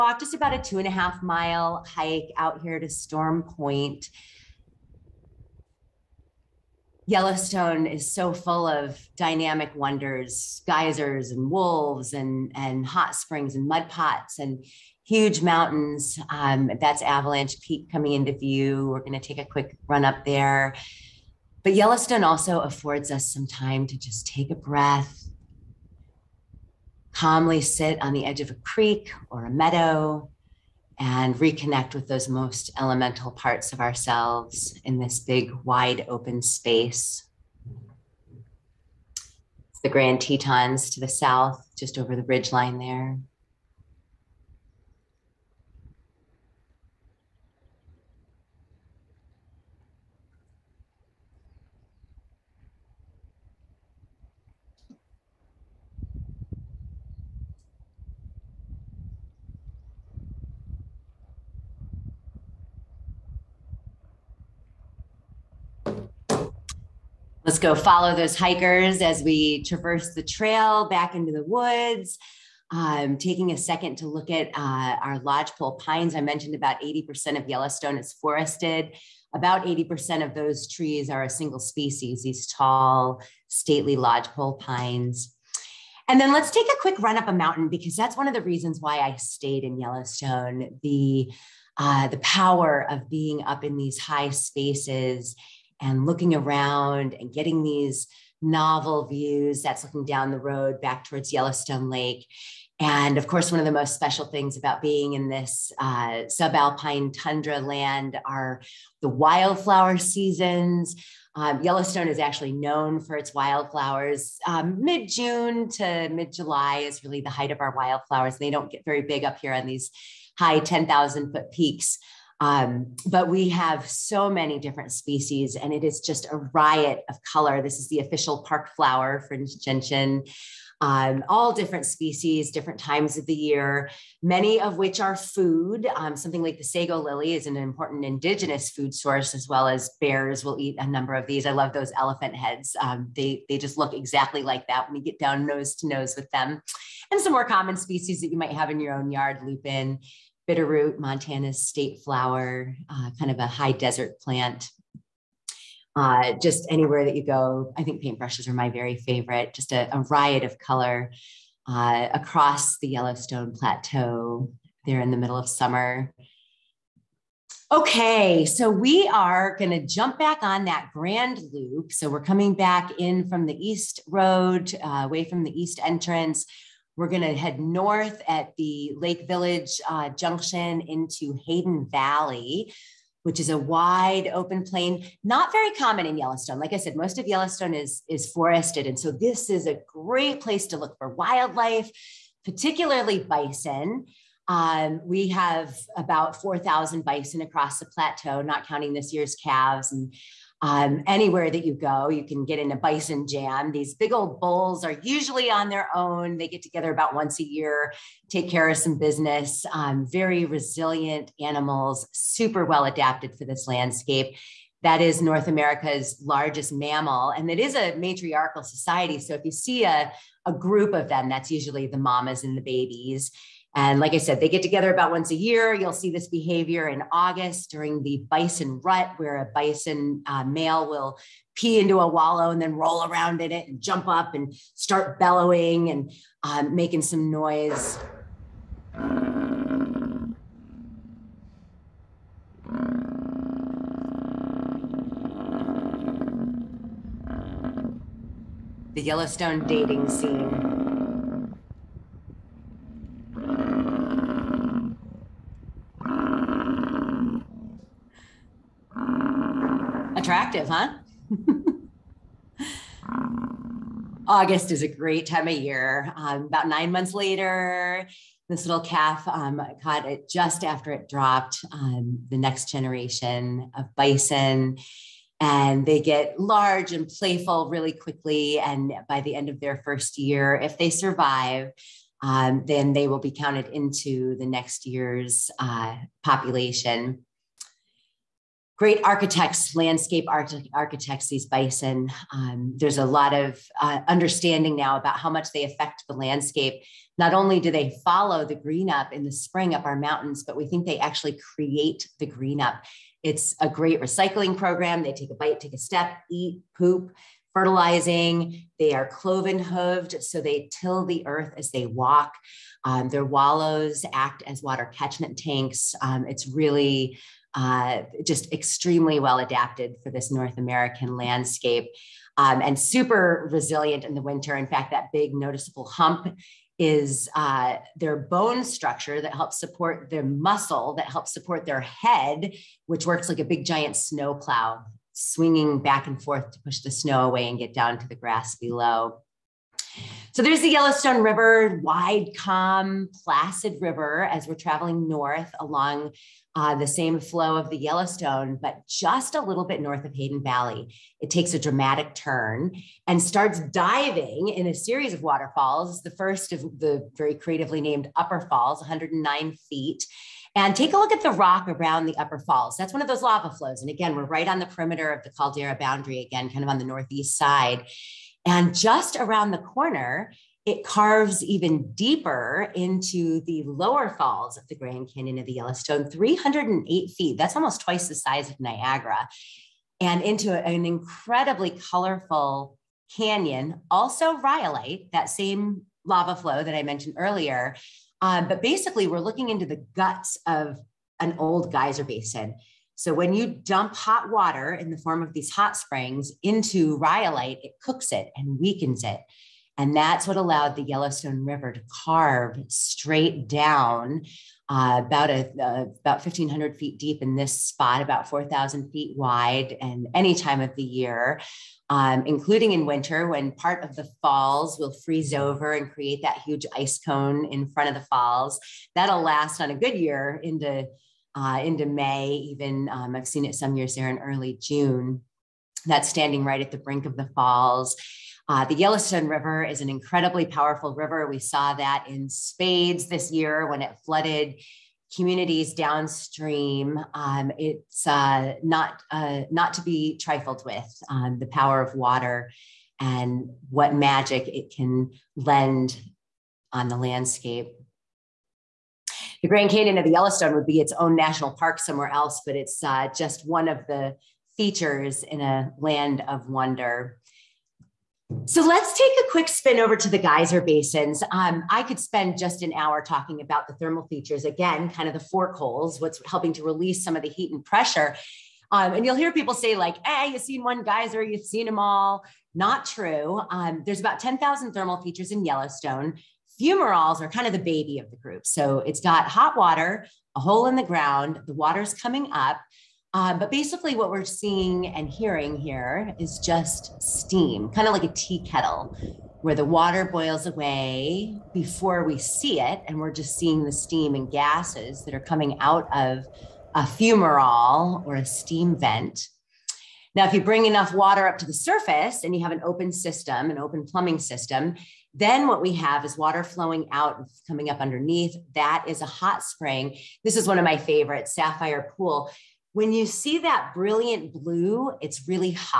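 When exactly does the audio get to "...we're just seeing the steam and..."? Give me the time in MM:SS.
08:12.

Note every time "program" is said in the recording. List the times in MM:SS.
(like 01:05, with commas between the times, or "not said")
05:04.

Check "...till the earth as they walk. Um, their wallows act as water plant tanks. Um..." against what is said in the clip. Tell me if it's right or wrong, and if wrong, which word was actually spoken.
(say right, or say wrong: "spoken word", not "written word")
wrong: "catchment", not "plant".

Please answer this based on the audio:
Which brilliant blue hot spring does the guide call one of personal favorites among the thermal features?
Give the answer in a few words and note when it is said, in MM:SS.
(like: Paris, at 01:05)
Sapphire Pool, at 08:31.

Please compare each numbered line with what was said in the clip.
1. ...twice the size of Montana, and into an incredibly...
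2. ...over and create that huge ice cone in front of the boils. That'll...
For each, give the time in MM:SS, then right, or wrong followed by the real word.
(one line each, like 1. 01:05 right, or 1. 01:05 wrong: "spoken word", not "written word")
1. 06:17 wrong: "Niagara", not "Montana"
2. 06:55 wrong: "falls", not "boils".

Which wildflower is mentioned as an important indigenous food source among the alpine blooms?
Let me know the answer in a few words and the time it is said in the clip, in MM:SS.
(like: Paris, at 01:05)
Sego lily, at 02:16.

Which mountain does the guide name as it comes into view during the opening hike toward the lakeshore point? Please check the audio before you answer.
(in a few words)
Avalanche Peak.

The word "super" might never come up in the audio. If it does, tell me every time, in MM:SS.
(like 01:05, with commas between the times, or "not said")
03:32, 05:22.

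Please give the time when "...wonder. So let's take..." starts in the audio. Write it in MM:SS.
07:36.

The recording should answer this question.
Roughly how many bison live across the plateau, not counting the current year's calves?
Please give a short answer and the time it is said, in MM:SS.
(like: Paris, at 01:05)
4,000, at 03:15.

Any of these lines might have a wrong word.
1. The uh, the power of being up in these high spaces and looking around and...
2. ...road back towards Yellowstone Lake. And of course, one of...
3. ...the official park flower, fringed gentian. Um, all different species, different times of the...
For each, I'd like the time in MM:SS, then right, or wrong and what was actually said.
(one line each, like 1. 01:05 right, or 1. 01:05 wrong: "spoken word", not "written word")
1. 01:30 right
2. 01:40 right
3. 02:07 right.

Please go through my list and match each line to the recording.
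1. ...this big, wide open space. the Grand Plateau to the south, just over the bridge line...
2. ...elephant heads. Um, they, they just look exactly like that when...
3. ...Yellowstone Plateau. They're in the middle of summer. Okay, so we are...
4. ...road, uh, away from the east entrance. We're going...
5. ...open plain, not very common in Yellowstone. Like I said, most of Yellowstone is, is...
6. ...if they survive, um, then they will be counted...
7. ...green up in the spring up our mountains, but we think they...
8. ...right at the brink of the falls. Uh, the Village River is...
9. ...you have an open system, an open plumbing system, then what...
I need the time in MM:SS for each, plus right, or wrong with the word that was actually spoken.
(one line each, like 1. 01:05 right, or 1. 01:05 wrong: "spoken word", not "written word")
1. 00:34 wrong: "Tetons", not "Plateau"
2. 02:21 right
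3. 02:42 right
4. 02:54 right
5. 03:04 right
6. 04:40 right
7. 04:58 right
8. 07:06 wrong: "Yellowstone", not "Village"
9. 08:22 right.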